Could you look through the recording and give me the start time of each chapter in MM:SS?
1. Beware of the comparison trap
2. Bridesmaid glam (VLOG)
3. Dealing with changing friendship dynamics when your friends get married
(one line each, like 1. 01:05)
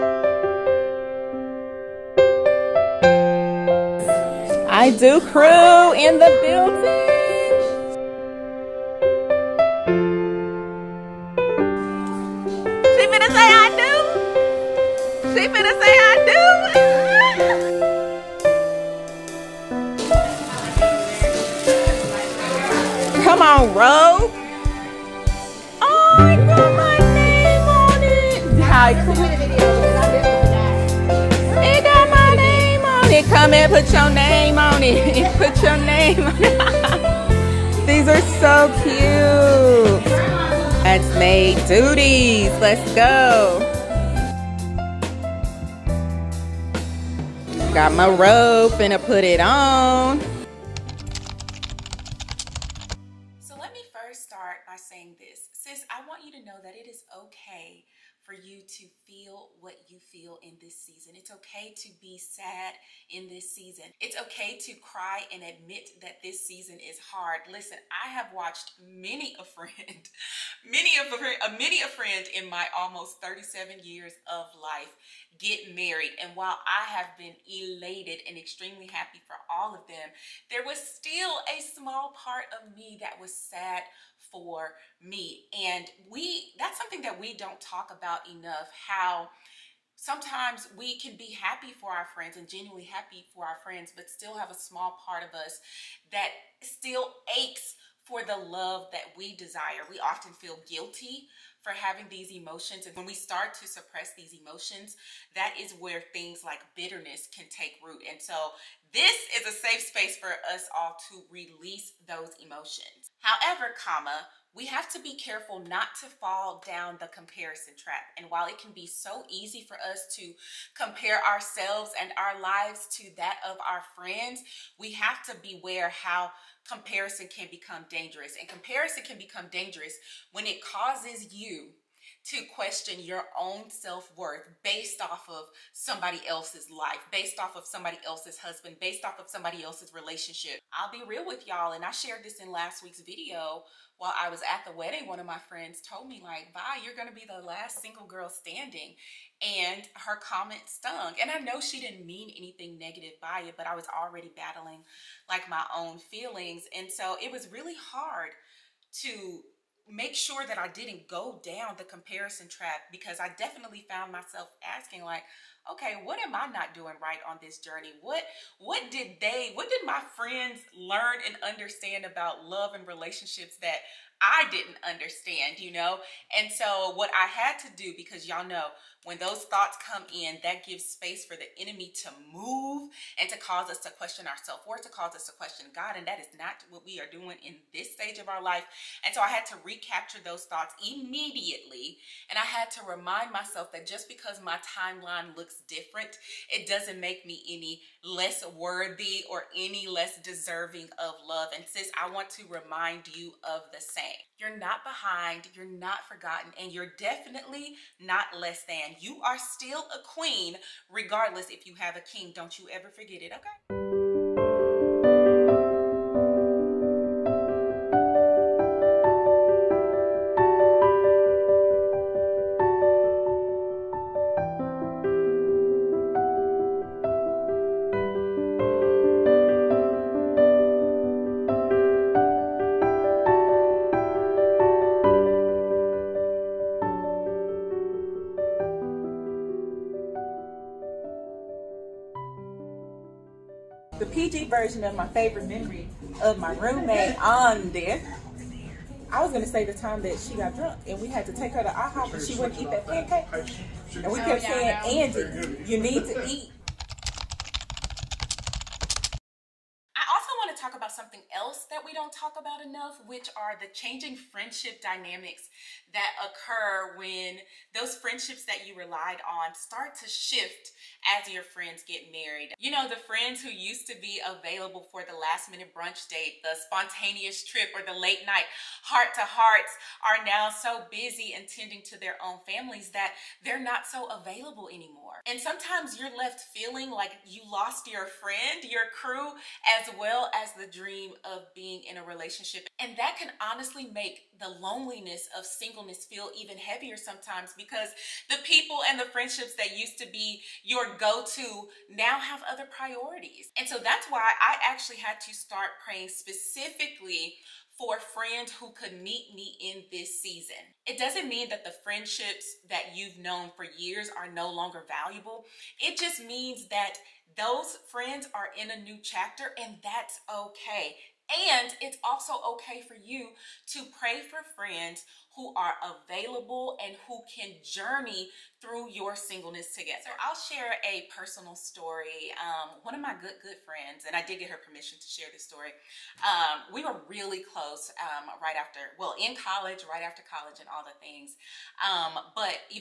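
1. 00:52
2. 03:32
3. 04:15.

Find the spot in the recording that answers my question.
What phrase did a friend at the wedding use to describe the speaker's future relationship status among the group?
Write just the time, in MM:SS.
02:27.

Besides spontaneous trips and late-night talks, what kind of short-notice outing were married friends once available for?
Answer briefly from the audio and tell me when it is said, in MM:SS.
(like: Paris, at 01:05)
last minute brunch date, at 04:35.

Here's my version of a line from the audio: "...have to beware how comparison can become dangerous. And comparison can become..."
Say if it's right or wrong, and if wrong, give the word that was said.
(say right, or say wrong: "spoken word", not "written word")
right.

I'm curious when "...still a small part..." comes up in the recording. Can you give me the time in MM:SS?
01:20.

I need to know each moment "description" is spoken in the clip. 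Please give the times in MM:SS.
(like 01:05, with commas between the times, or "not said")
not said.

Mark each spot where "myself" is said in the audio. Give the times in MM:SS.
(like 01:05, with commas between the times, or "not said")
02:44, 03:13.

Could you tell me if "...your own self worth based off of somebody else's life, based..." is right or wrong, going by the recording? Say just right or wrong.
right.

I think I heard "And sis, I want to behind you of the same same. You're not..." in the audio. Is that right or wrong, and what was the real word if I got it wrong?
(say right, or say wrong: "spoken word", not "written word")
wrong: "remind", not "behind".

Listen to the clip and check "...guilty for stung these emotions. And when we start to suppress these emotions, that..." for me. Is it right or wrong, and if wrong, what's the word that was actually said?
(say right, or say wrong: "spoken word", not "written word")
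wrong: "having", not "stung".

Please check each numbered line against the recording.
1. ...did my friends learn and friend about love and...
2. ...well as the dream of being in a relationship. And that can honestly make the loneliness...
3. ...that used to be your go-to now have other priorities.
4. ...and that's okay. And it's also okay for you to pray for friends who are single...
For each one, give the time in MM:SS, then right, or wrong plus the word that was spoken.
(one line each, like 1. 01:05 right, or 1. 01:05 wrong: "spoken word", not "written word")
1. 02:49 wrong: "understand", not "friend"
2. 04:49 right
3. 04:59 right
4. 05:19 wrong: "available", not "single".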